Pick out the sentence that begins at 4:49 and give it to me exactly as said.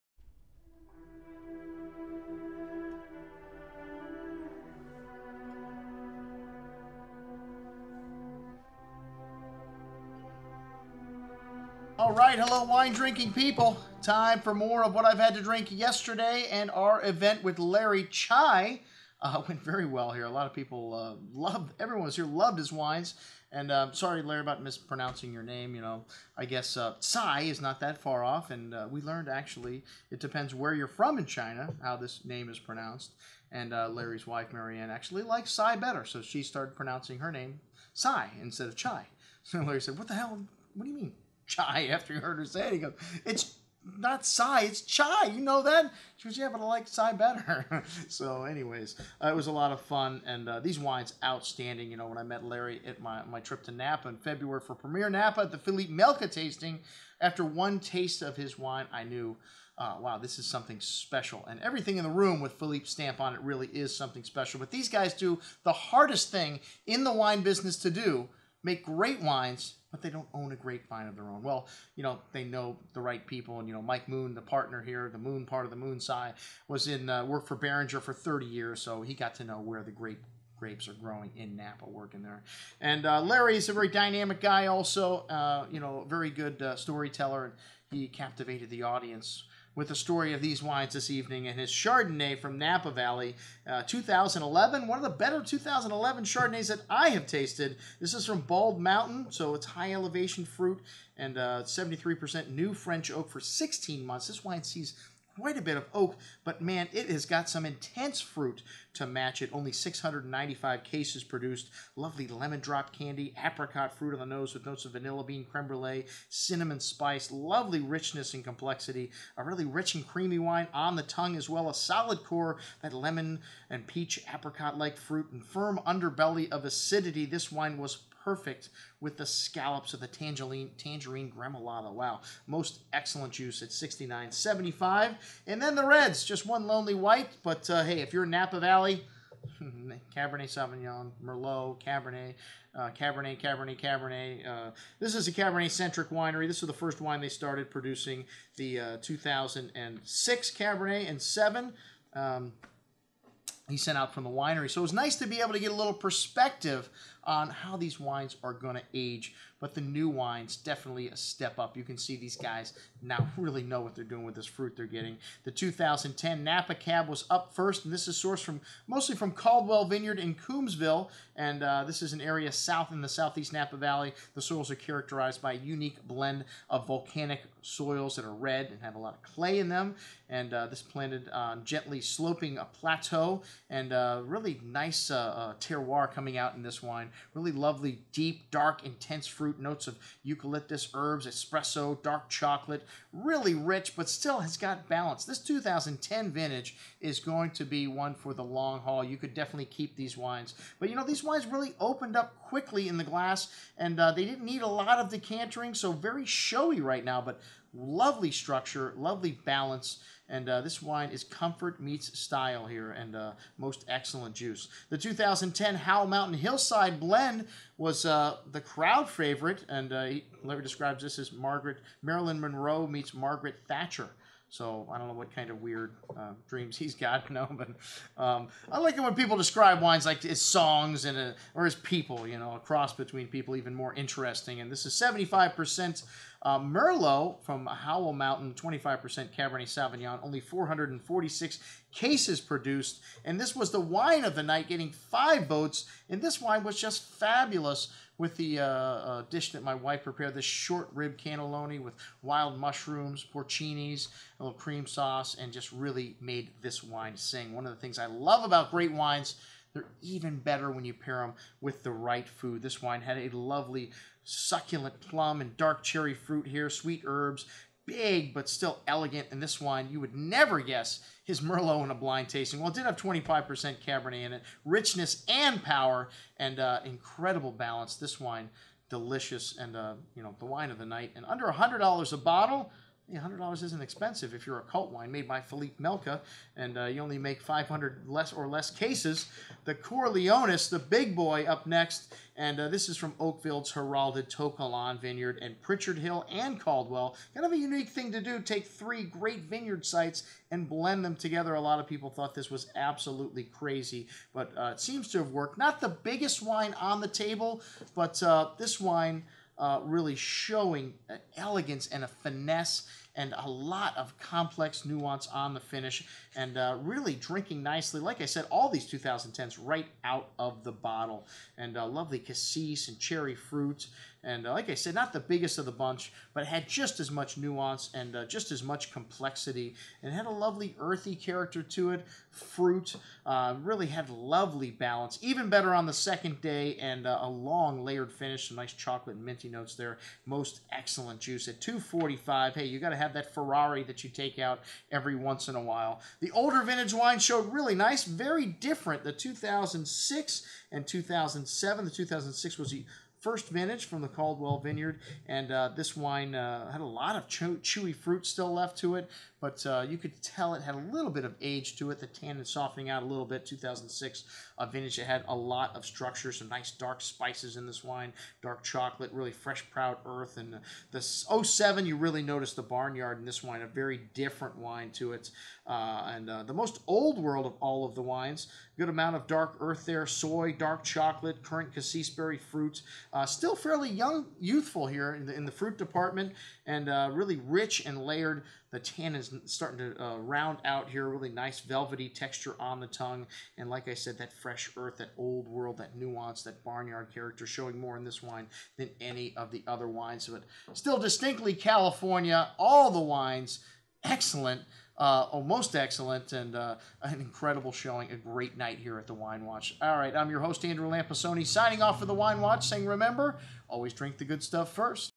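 The Corleonis, the big boy, up next, and uh, this is from Oakville's Heralded To Kalon Vineyard and Pritchard Hill and Caldwell.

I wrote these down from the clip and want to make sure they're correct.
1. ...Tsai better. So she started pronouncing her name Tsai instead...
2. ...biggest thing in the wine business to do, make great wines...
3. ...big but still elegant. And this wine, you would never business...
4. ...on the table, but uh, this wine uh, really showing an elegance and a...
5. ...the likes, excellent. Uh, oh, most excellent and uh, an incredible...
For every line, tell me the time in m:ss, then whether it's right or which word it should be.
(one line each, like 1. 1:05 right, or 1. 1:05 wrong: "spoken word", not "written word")
1. 0:35 right
2. 1:05 wrong: "hardest", not "biggest"
3. 4:27 wrong: "guess", not "business"
4. 5:06 right
5. 6:42 wrong: "wines", not "likes".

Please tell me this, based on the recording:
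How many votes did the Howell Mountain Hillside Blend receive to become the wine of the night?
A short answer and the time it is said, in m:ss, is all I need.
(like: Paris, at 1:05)
5, at 4:04.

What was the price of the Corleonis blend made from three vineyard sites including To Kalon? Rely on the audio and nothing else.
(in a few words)
$245.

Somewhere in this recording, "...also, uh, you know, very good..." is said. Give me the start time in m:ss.
1:24.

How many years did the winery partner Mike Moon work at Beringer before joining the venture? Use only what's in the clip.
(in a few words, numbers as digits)
30 years.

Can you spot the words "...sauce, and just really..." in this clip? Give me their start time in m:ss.
4:14.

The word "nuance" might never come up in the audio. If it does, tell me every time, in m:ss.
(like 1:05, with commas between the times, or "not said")
5:14, 5:27, 6:35.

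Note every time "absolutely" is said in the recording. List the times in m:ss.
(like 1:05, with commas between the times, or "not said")
5:02.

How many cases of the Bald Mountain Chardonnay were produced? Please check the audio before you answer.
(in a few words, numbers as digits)
695.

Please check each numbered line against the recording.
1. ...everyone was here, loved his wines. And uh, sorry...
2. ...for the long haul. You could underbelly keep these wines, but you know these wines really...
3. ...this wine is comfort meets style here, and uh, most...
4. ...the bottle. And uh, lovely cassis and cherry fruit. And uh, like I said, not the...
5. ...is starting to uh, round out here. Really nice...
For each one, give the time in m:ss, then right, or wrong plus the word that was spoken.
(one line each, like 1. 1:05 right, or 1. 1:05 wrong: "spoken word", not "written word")
1. 0:21 right
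2. 3:18 wrong: "definitely", not "underbelly"
3. 3:30 right
4. 5:20 right
5. 6:29 right.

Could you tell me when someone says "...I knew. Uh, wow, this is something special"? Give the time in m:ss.
0:58.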